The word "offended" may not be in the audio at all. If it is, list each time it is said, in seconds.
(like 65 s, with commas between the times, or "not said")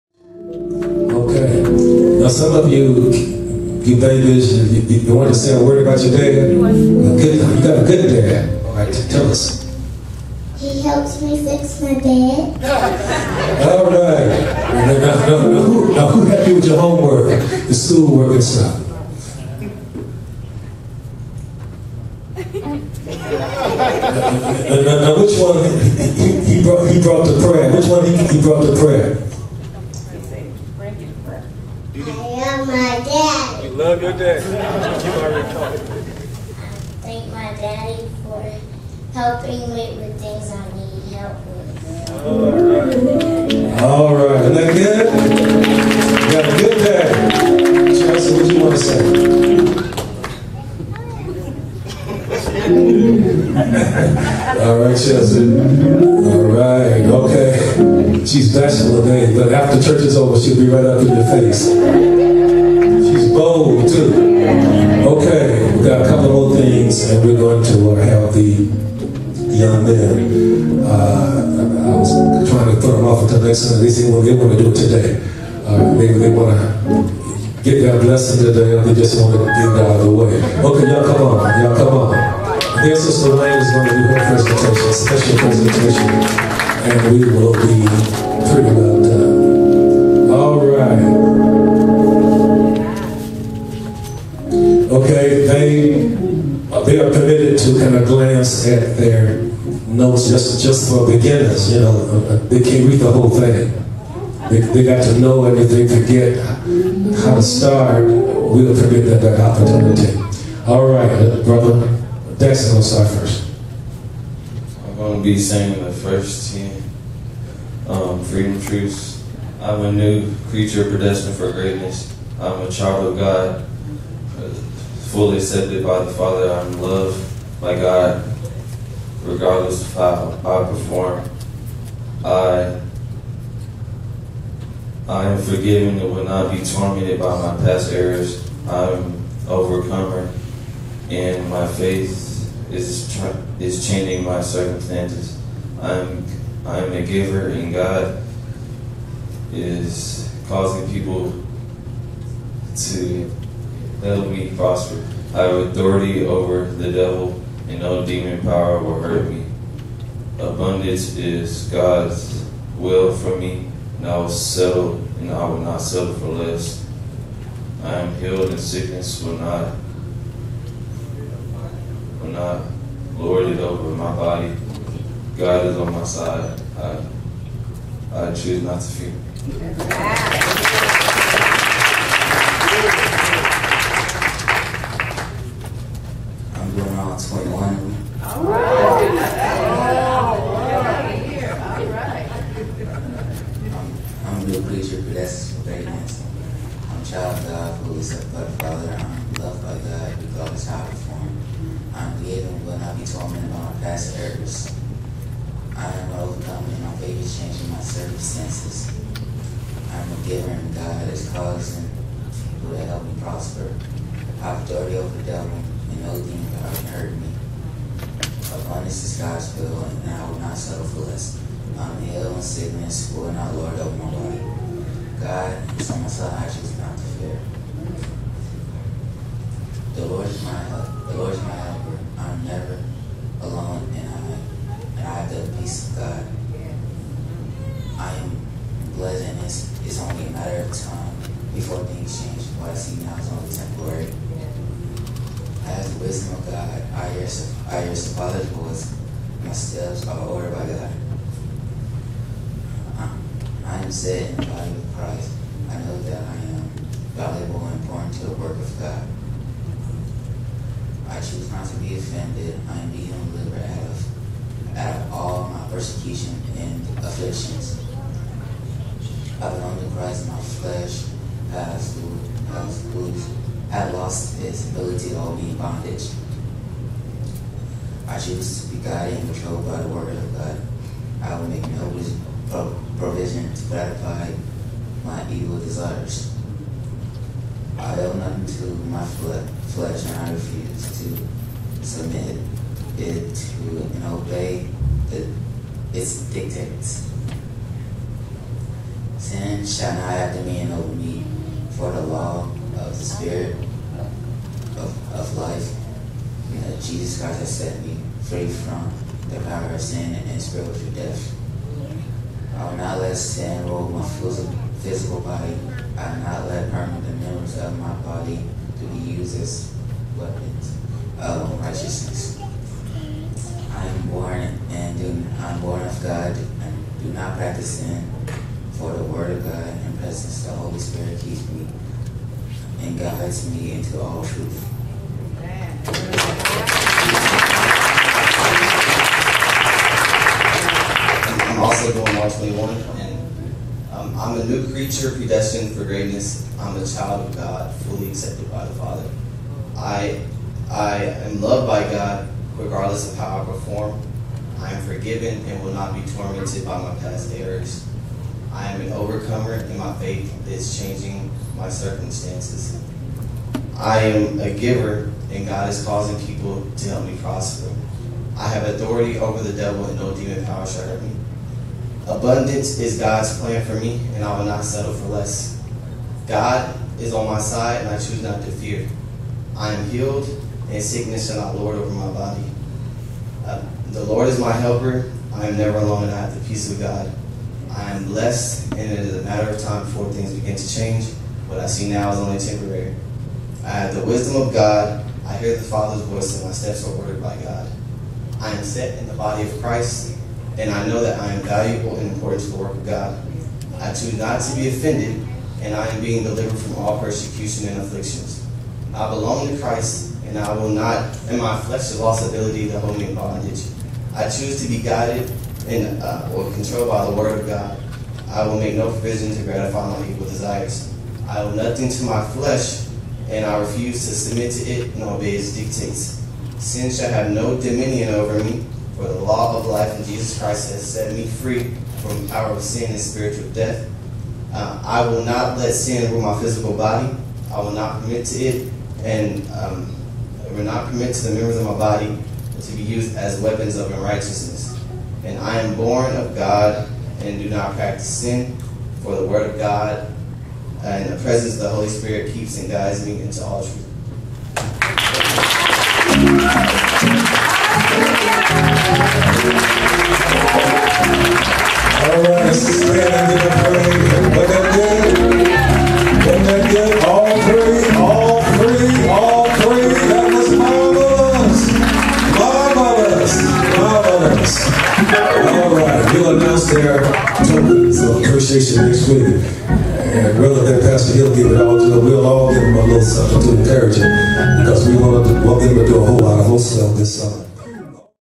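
261 s, 404 s.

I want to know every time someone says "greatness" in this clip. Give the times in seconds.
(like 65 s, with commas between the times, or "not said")
121 s, 345 s.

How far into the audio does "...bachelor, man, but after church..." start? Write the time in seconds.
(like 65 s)
58 s.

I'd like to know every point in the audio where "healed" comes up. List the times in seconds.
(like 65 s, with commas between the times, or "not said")
168 s, 379 s.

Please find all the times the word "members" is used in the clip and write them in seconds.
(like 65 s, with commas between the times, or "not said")
317 s, 441 s.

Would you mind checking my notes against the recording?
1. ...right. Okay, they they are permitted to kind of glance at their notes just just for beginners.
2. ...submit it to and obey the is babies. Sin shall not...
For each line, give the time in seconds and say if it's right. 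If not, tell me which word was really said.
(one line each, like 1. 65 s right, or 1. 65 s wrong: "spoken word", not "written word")
1. 90 s right
2. 291 s wrong: "dictates", not "babies".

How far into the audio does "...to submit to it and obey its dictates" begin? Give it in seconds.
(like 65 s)
424 s.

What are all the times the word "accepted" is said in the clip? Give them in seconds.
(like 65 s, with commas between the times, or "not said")
125 s, 348 s.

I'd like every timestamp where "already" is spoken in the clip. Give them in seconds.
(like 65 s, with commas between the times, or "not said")
35 s.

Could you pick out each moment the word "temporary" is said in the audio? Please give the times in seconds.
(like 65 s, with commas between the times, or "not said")
243 s, 392 s.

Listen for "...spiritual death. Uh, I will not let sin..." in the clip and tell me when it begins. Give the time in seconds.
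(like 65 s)
432 s.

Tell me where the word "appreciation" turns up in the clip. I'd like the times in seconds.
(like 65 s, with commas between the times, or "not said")
478 s.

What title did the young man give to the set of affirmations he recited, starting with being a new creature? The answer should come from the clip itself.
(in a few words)
freedom truths.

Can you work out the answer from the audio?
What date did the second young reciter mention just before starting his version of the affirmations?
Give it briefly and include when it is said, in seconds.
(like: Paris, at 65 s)
March 21, at 342 s.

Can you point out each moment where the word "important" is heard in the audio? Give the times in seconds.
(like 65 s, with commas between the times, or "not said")
257 s, 402 s.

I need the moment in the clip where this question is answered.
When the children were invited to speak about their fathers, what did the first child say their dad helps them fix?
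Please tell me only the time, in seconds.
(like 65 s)
10 s.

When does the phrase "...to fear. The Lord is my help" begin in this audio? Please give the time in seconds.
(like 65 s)
226 s.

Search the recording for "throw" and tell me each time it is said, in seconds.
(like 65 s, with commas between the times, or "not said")
72 s.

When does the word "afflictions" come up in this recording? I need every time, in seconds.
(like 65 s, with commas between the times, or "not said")
266 s, 407 s.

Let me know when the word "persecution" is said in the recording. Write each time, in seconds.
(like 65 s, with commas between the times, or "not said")
265 s, 406 s.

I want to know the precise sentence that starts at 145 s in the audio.
I'm I'm a giver, and God is causing people to help me prosper.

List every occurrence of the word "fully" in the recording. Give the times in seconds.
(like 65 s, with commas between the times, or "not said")
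125 s, 347 s.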